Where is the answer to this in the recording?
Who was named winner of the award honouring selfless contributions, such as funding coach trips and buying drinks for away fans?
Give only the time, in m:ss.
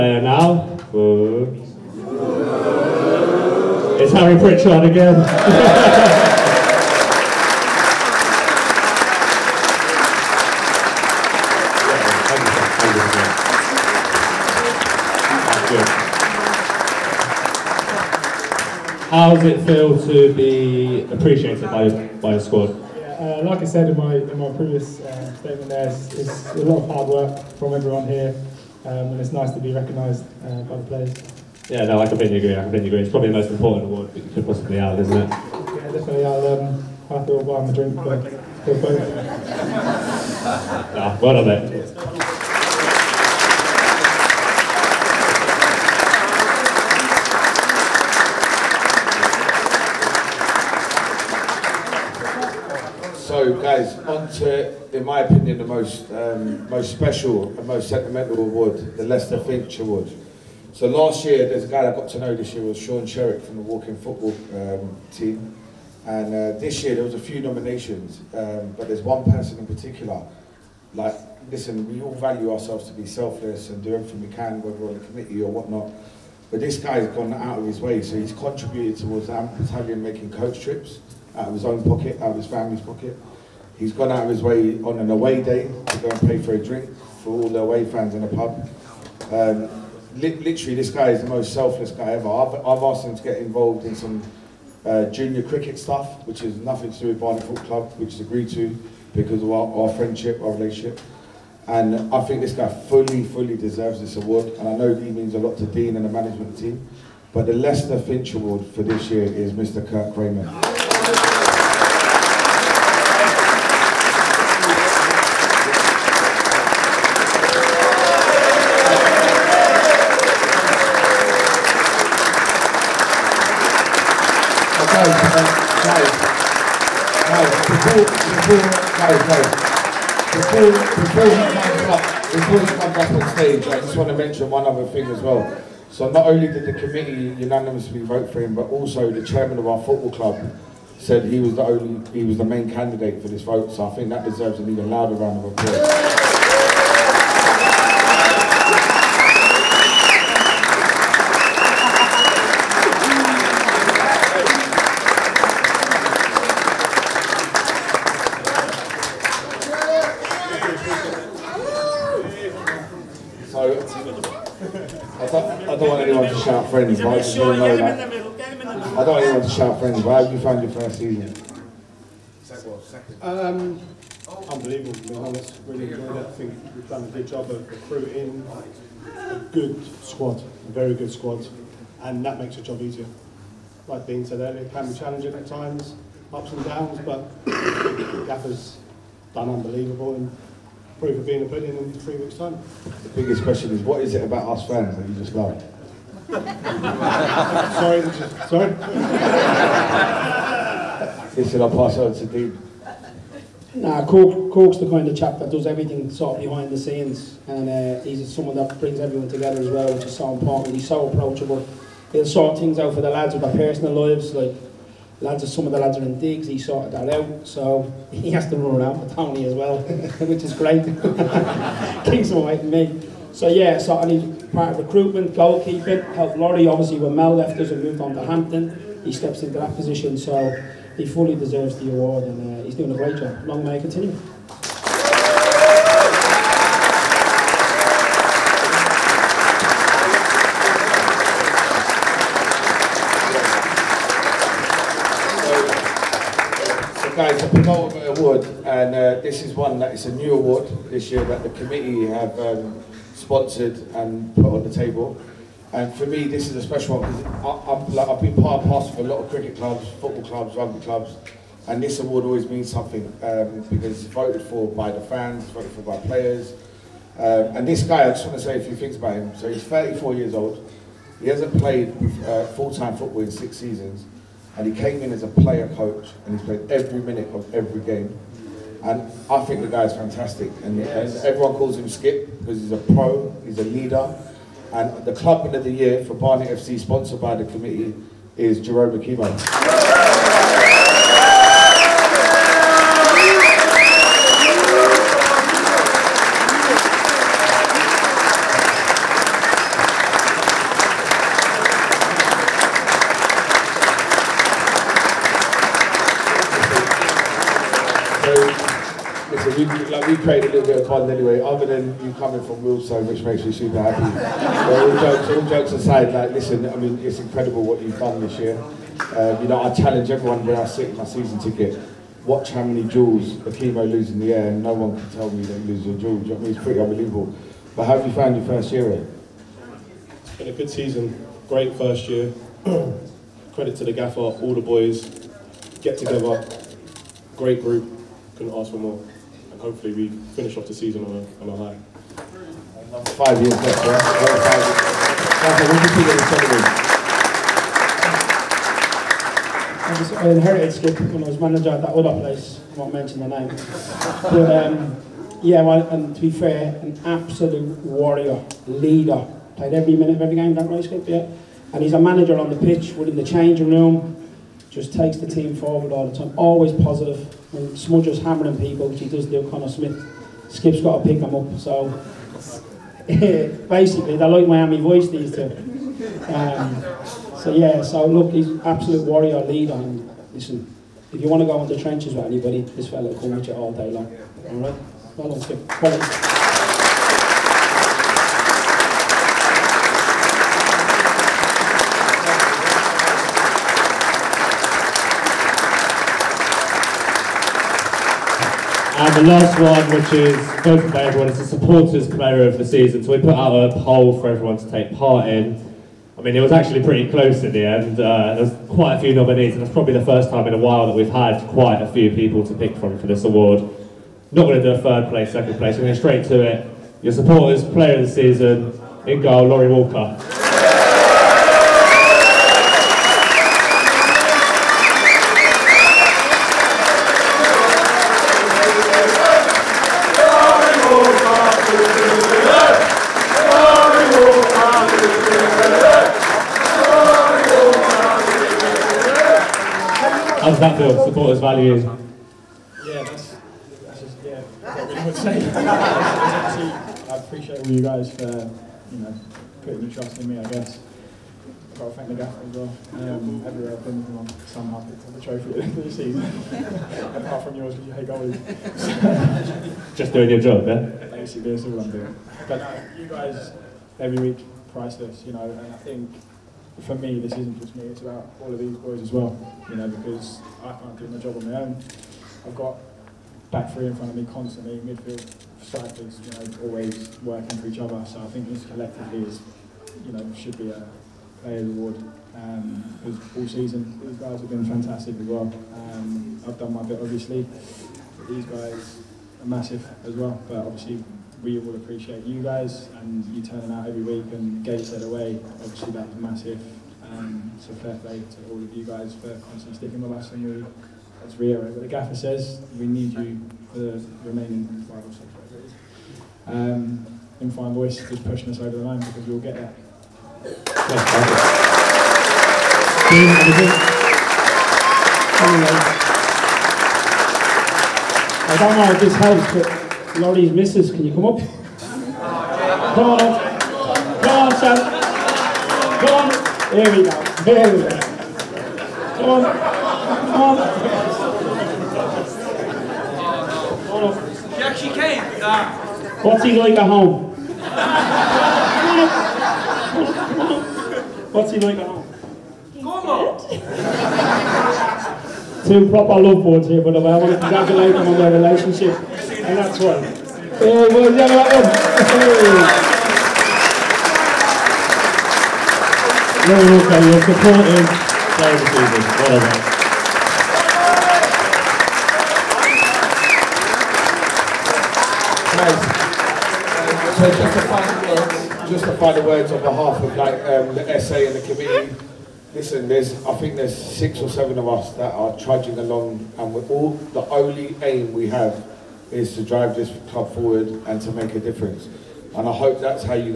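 1:49.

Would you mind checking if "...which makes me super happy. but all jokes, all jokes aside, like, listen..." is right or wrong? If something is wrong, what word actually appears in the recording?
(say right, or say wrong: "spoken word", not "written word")
right.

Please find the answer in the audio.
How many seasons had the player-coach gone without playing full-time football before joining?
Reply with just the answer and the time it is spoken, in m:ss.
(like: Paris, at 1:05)
6, at 4:33.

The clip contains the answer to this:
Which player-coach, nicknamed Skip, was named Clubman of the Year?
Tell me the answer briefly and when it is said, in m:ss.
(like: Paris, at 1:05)
Jerome McKeeman, at 4:48.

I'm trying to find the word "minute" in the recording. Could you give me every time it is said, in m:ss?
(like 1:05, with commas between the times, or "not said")
4:37, 5:59.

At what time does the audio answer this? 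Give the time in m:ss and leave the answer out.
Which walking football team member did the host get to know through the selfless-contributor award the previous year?
1:02.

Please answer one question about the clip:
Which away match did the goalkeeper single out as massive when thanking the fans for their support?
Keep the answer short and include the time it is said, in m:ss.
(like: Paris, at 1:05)
Gateshead, at 8:14.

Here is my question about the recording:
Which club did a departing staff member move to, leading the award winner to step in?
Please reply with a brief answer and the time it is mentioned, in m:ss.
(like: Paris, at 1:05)
Hampton, at 3:48.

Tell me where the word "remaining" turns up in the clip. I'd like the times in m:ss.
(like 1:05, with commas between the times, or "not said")
8:24.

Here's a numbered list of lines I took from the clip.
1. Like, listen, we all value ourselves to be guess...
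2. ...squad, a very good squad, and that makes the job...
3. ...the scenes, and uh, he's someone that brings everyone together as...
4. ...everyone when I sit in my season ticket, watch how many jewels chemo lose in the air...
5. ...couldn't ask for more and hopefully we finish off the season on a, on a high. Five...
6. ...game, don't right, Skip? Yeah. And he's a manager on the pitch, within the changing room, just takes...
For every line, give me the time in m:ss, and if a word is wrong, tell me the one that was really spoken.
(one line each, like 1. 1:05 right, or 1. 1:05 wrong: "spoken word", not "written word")
1. 1:10 wrong: "selfless", not "guess"
2. 3:00 right
3. 3:26 right
4. 5:20 right
5. 5:38 right
6. 6:00 right.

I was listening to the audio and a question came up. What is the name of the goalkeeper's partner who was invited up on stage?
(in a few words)
Sam.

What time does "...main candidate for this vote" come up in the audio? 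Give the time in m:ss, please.
2:22.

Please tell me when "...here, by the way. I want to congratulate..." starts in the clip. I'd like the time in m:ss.
9:06.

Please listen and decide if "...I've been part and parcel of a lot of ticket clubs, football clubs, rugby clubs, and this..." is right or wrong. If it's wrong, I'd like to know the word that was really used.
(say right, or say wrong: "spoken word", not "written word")
wrong: "cricket", not "ticket".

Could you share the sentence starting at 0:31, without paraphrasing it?
Yeah, no, I completely agree, I completely agree.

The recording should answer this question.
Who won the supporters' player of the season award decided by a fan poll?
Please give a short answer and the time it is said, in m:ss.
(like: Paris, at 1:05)
Laurie Walker, at 6:59.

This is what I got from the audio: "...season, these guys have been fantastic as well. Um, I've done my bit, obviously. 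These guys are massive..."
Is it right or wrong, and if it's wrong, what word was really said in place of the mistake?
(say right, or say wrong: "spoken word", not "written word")
right.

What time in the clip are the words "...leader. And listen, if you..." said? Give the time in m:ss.
6:19.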